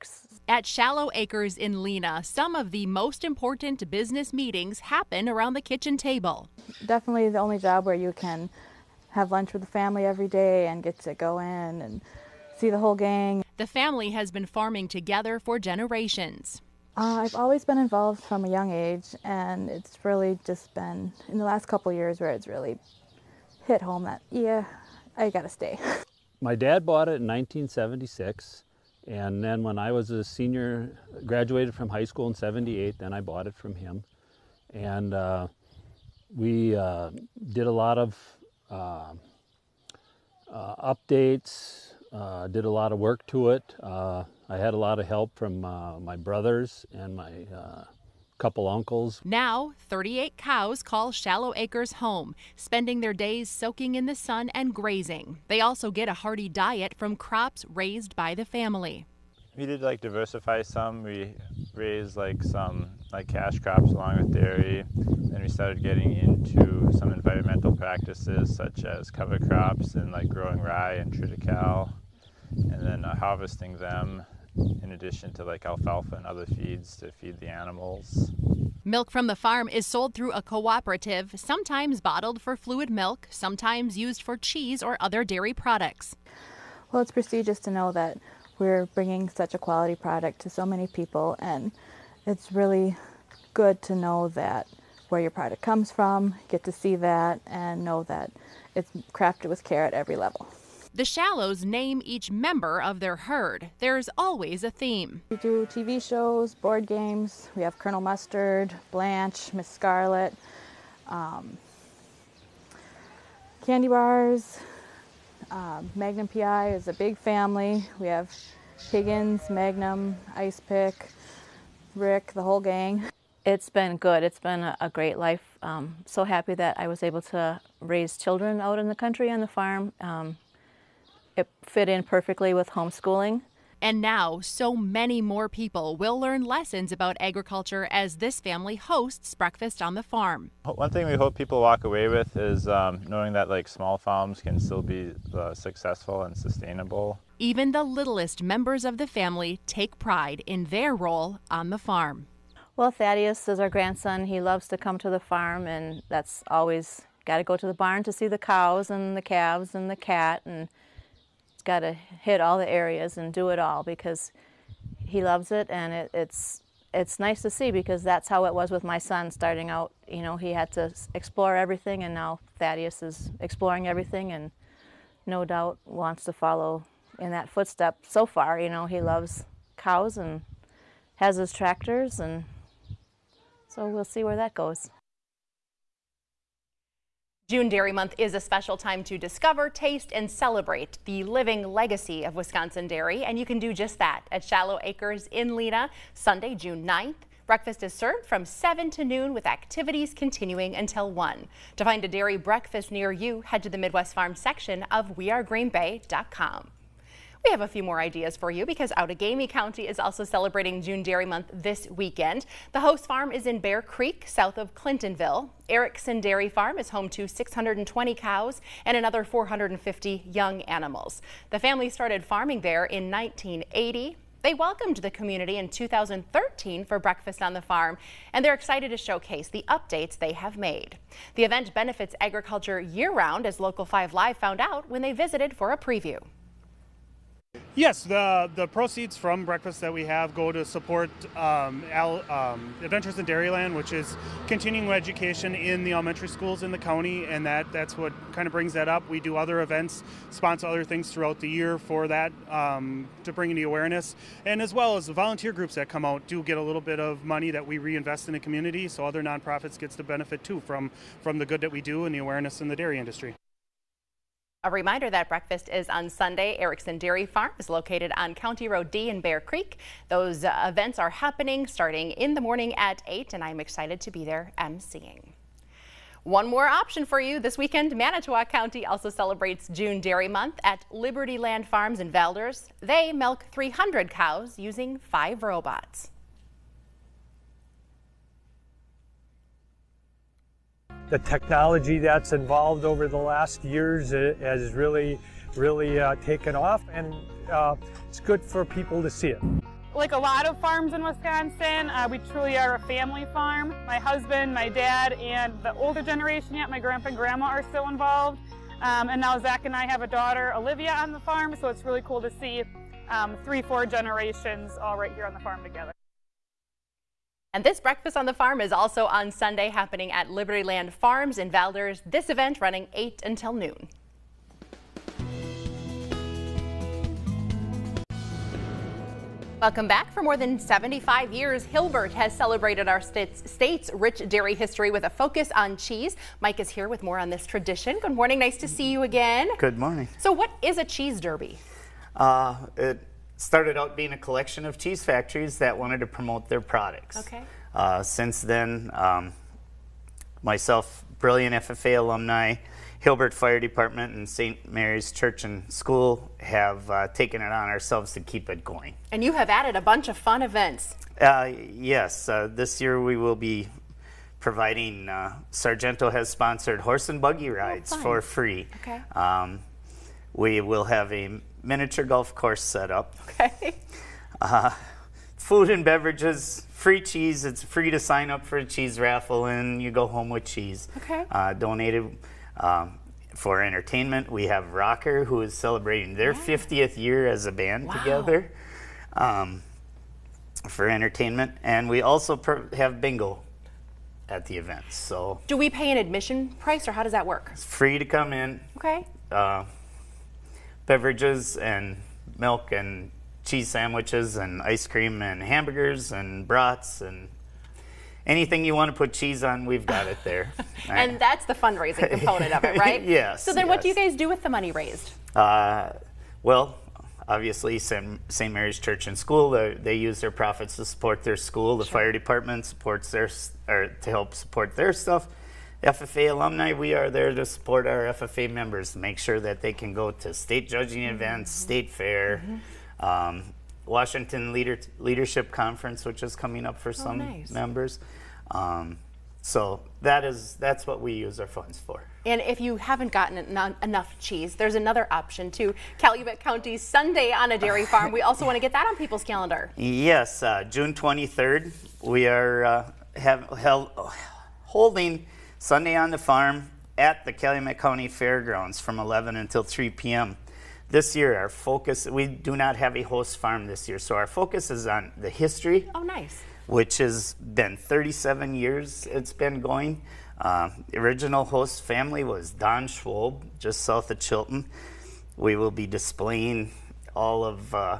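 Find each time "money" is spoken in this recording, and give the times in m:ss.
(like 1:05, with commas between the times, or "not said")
4:17, 6:54.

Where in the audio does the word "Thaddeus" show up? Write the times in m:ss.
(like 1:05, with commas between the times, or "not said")
2:32, 2:52.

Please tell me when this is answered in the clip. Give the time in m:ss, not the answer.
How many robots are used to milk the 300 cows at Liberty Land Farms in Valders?
4:44.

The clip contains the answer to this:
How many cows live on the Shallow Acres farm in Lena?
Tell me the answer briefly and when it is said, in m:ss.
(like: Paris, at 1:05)
38, at 0:49.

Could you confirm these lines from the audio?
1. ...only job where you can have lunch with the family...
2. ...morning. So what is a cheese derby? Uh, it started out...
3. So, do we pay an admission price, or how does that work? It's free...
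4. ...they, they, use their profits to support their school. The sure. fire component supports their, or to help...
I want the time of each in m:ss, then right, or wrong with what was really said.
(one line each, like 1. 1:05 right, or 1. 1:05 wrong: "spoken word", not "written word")
1. 0:07 right
2. 5:39 right
3. 6:34 right
4. 6:59 wrong: "department", not "component".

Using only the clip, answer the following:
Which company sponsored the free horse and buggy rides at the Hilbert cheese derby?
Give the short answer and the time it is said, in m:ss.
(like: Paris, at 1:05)
Sargento, at 6:05.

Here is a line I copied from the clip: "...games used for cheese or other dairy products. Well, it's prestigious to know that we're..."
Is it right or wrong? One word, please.
wrong.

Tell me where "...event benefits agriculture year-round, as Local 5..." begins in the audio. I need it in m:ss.
3:51.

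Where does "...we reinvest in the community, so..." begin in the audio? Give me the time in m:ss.
4:17.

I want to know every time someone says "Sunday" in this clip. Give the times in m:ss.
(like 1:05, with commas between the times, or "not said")
3:16, 4:26, 5:19, 7:26, 7:35.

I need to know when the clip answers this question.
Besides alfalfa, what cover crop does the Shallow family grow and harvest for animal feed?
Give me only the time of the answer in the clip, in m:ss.
1:11.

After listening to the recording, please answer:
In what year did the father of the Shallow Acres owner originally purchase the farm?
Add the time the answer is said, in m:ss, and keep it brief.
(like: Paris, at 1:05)
1976, at 0:27.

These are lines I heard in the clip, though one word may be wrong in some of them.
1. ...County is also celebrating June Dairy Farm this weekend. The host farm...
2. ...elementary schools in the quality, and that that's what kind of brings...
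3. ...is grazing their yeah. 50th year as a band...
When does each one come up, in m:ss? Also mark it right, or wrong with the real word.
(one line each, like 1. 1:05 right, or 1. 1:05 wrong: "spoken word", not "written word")
1. 3:29 wrong: "Month", not "Farm"
2. 4:05 wrong: "county", not "quality"
3. 6:25 wrong: "celebrating", not "grazing".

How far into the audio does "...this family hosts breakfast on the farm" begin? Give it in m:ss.
2:18.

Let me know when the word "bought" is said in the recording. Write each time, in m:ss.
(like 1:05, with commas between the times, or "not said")
0:26, 0:33.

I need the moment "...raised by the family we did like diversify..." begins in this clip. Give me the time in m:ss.
0:57.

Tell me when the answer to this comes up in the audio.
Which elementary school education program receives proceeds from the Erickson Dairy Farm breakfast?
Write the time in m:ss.
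4:02.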